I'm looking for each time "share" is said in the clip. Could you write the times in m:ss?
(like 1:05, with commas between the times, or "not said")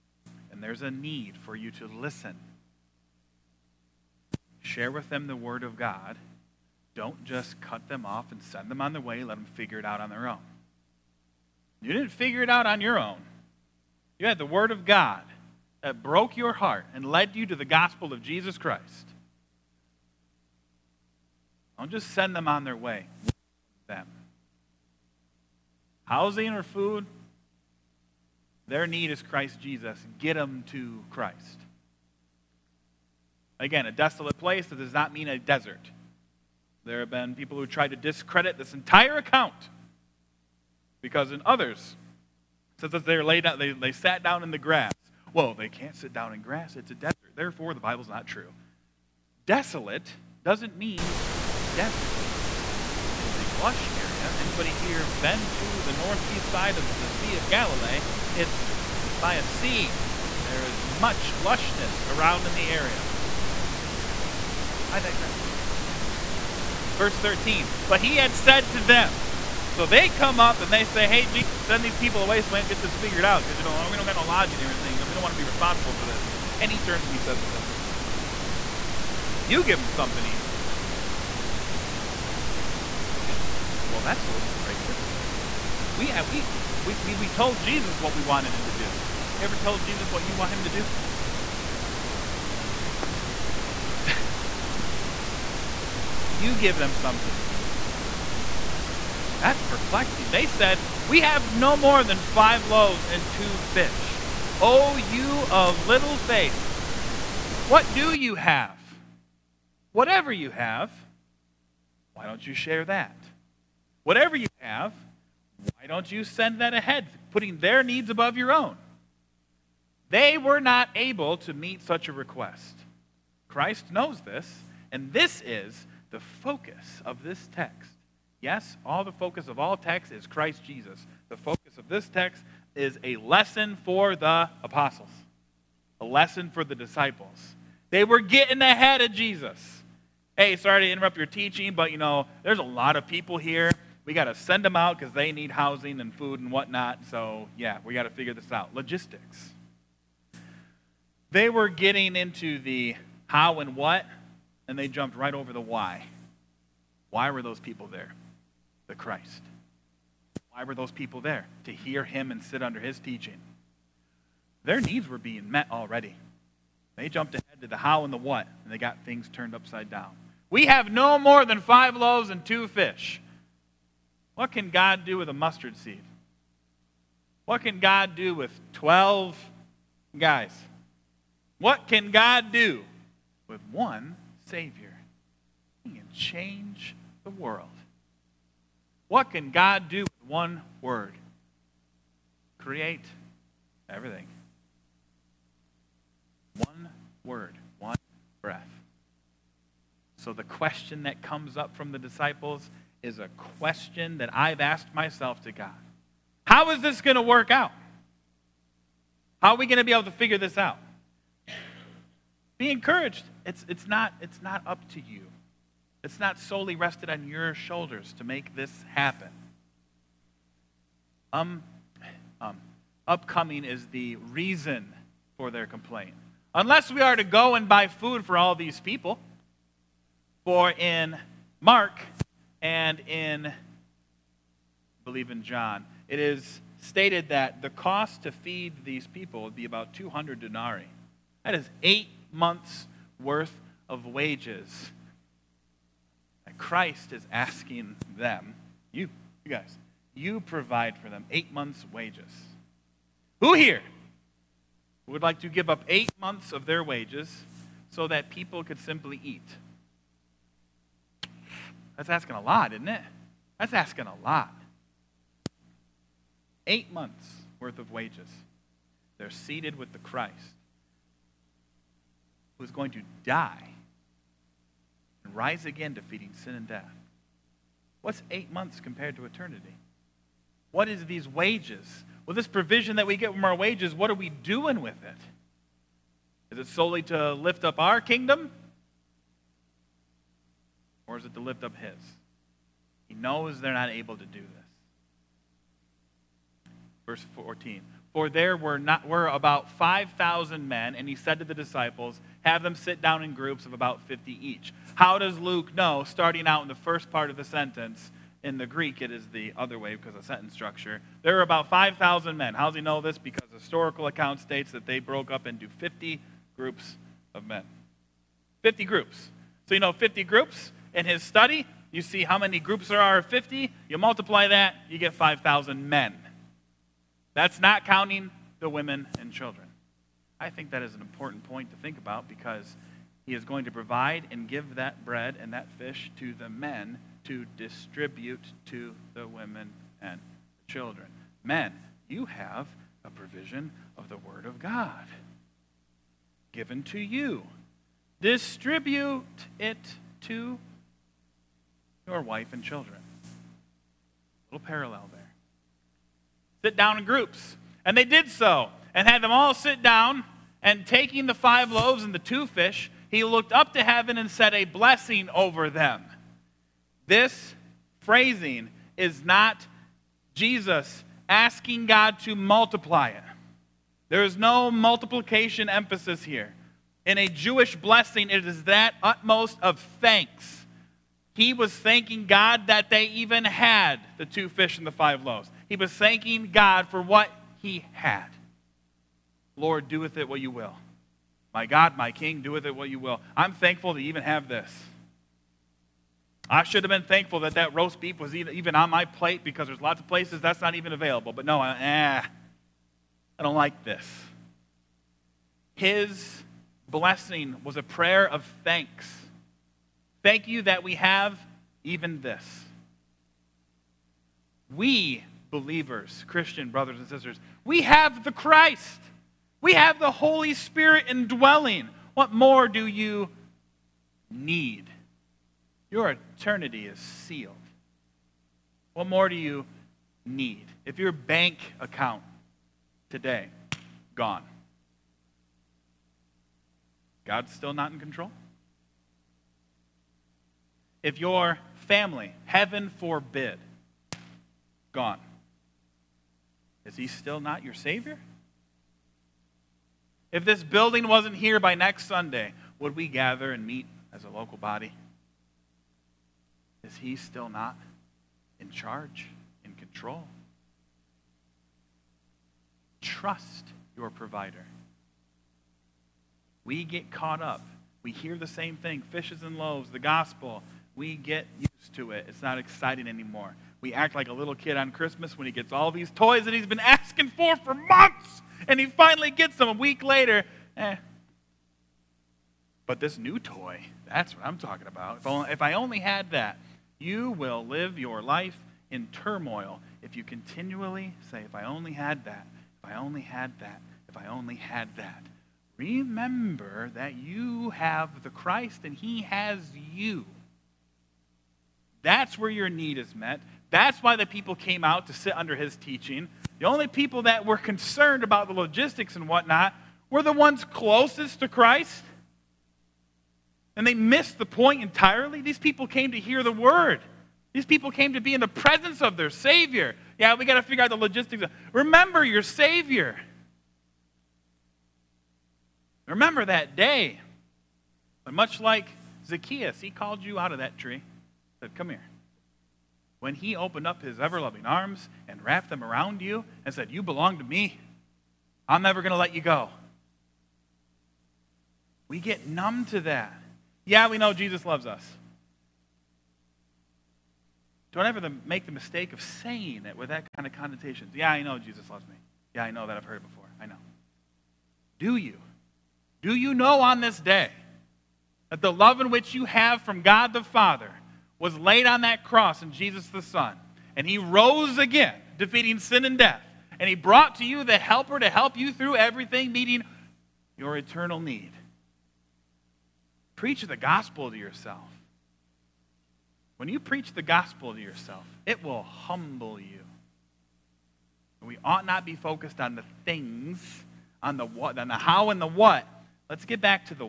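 0:04, 1:52.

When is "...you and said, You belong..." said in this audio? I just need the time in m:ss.
8:56.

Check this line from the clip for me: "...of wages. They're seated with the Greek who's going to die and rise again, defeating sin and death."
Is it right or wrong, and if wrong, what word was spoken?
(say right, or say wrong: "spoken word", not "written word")
wrong: "Christ", not "Greek".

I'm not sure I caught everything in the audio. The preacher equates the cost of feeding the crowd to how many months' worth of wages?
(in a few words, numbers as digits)
8.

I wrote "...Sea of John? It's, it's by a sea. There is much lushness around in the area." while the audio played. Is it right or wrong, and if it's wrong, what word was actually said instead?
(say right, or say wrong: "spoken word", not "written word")
wrong: "Galilee", not "John".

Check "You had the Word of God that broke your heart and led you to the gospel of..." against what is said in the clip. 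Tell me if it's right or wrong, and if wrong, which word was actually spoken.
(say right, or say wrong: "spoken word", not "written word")
right.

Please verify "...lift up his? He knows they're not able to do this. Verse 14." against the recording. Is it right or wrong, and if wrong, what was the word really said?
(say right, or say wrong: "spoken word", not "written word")
right.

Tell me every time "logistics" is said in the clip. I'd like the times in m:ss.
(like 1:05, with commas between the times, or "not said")
2:28, 8:28, 8:40.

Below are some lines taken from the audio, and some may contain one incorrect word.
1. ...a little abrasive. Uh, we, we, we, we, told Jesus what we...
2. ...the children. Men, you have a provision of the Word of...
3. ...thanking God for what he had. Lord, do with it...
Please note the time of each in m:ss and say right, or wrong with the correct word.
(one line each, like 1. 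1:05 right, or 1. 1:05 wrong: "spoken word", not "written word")
1. 1:24 right
2. 5:40 right
3. 6:25 right.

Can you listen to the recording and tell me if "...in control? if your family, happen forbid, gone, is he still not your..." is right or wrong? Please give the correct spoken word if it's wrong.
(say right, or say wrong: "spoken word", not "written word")
wrong: "heaven", not "happen".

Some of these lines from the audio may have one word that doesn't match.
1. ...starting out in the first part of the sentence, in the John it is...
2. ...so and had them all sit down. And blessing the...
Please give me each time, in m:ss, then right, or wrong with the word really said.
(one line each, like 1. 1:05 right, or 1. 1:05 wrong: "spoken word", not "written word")
1. 5:06 wrong: "Greek", not "John"
2. 5:58 wrong: "taking", not "blessing".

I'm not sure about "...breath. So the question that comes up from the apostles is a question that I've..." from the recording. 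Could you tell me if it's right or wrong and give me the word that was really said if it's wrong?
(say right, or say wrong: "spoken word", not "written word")
wrong: "disciples", not "apostles".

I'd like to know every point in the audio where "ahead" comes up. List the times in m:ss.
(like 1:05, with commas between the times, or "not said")
1:56, 2:18, 2:47.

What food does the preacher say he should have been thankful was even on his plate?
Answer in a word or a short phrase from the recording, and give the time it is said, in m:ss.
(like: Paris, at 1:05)
Roast beef, at 6:37.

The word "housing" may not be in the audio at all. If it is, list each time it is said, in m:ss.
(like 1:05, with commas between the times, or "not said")
0:26, 2:25.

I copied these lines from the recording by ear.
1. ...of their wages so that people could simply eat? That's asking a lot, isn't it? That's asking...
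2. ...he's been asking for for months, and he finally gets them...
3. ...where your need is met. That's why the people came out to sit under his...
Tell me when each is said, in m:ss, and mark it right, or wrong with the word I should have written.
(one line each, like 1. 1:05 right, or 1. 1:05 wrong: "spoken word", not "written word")
1. 4:16 right
2. 7:56 right
3. 8:22 right.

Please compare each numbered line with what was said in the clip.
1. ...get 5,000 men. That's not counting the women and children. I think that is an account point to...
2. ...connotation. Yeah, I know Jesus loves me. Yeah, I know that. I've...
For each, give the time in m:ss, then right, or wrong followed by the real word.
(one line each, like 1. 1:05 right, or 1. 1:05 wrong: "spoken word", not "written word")
1. 5:24 wrong: "important", not "account"
2. 9:10 right.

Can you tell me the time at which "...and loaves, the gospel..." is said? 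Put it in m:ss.
7:49.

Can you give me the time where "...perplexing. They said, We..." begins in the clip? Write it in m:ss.
1:39.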